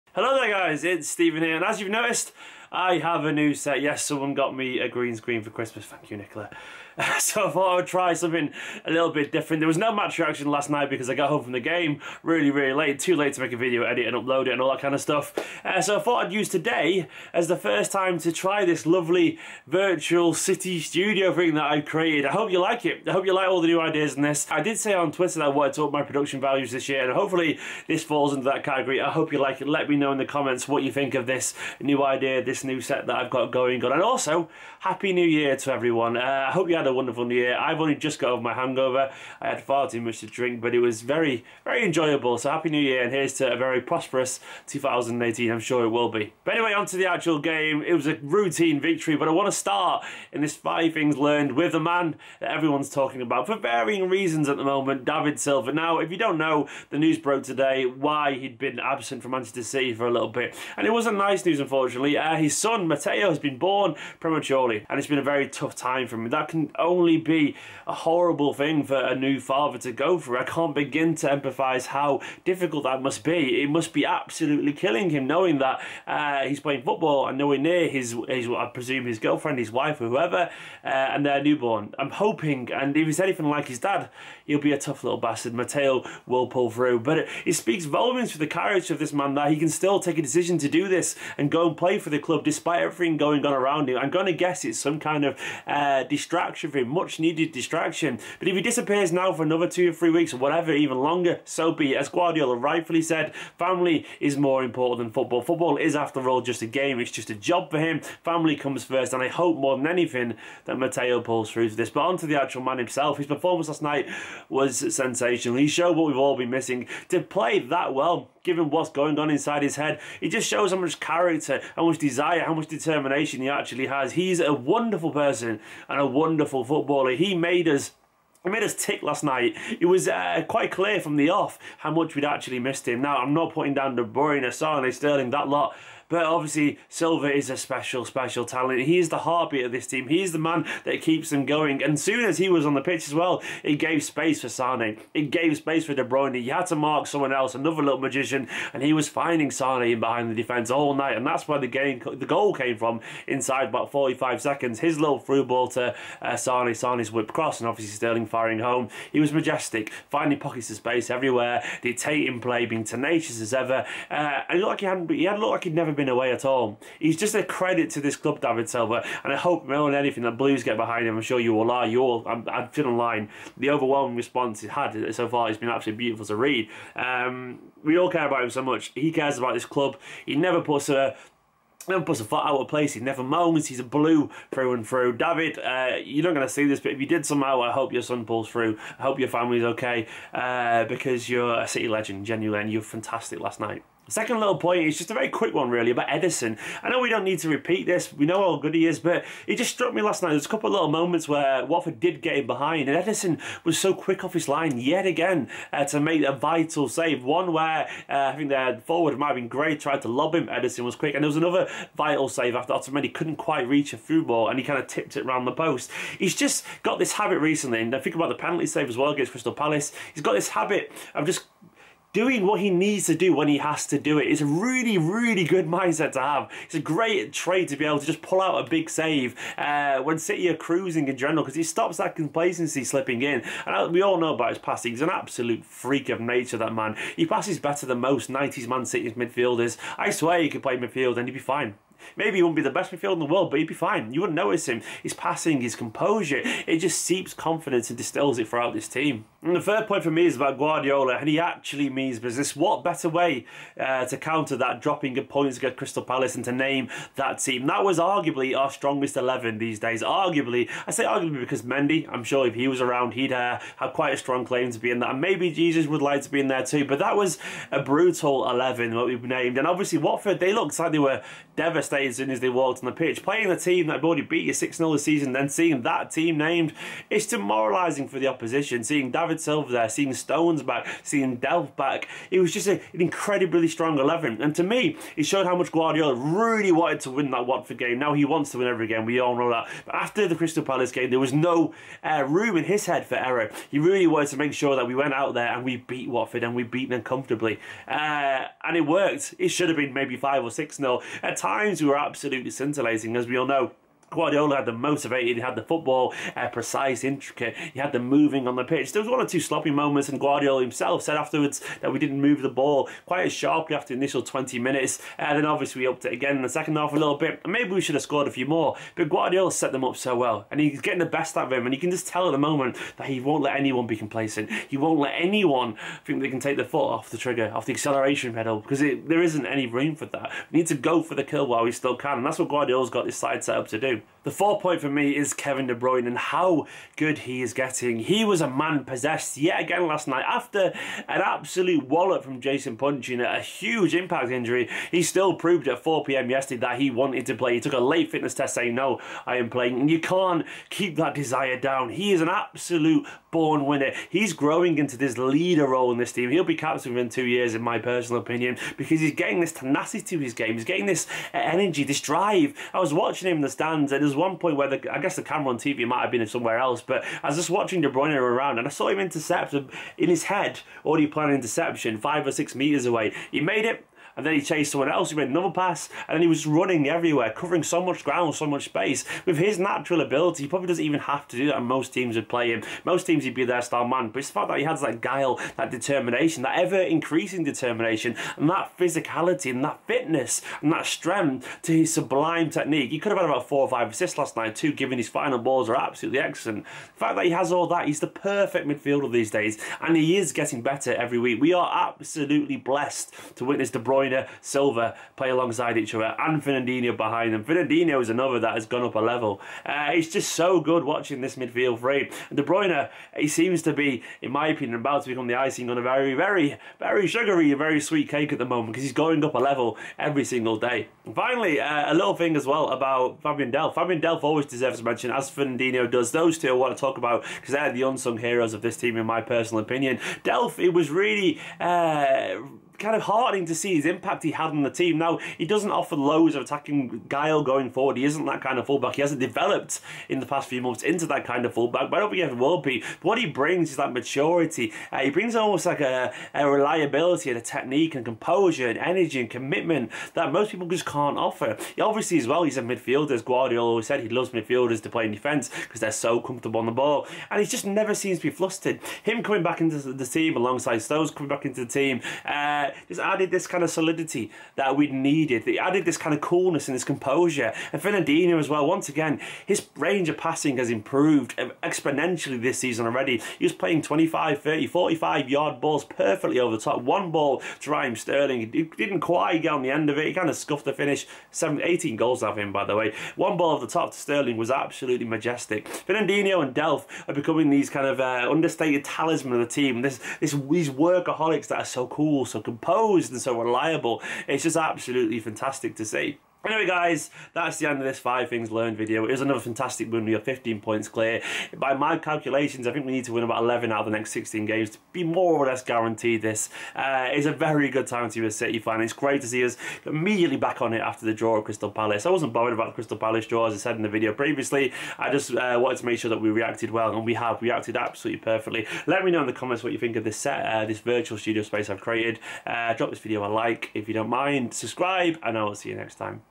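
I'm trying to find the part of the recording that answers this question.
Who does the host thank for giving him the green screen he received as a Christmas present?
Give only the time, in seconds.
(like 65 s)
6 s.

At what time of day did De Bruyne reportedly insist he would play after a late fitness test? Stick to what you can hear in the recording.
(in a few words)
4pm.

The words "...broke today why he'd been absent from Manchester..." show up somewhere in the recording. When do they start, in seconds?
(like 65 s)
57 s.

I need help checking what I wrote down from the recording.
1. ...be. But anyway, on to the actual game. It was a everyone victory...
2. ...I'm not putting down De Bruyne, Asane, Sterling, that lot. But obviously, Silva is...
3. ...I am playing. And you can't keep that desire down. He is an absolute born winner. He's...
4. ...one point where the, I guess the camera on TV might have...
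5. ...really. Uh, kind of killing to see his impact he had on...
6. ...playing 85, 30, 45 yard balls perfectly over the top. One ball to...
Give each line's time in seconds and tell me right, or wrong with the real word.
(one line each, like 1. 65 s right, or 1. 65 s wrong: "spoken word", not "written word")
1. 46 s wrong: "routine", not "everyone"
2. 133 s right
3. 349 s right
4. 364 s right
5. 430 s wrong: "heartening", not "killing"
6. 473 s wrong: "25", not "85".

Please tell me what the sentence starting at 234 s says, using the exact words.
He's an absolute freak of nature, that man.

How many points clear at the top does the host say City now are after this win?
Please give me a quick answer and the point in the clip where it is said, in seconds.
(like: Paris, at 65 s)
15, at 500 s.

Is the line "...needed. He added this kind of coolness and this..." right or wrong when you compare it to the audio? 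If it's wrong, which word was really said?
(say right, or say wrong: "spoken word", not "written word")
right.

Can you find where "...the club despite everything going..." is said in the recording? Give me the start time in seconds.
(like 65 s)
92 s.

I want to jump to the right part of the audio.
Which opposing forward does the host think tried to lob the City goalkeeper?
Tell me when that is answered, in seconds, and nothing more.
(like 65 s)
209 s.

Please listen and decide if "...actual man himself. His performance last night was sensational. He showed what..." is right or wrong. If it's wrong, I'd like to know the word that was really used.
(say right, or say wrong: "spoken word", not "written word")
right.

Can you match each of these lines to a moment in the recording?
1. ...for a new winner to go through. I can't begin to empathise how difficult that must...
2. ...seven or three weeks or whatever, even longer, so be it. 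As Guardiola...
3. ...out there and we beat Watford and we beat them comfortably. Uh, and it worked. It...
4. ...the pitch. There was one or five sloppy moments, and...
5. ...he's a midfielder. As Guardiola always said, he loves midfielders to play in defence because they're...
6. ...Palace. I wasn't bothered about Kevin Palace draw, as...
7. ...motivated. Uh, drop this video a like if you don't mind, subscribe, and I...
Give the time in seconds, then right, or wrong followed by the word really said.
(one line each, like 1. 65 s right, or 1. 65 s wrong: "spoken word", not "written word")
1. 68 s wrong: "father", not "winner"
2. 99 s wrong: "two", not "seven"
3. 295 s right
4. 308 s wrong: "two", not "five"
5. 452 s right
6. 511 s wrong: "Crystal", not "Kevin"
7. 521 s wrong: "created", not "motivated".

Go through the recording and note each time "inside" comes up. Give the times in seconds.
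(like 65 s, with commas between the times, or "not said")
119 s, 153 s.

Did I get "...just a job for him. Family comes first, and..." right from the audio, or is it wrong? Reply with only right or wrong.
right.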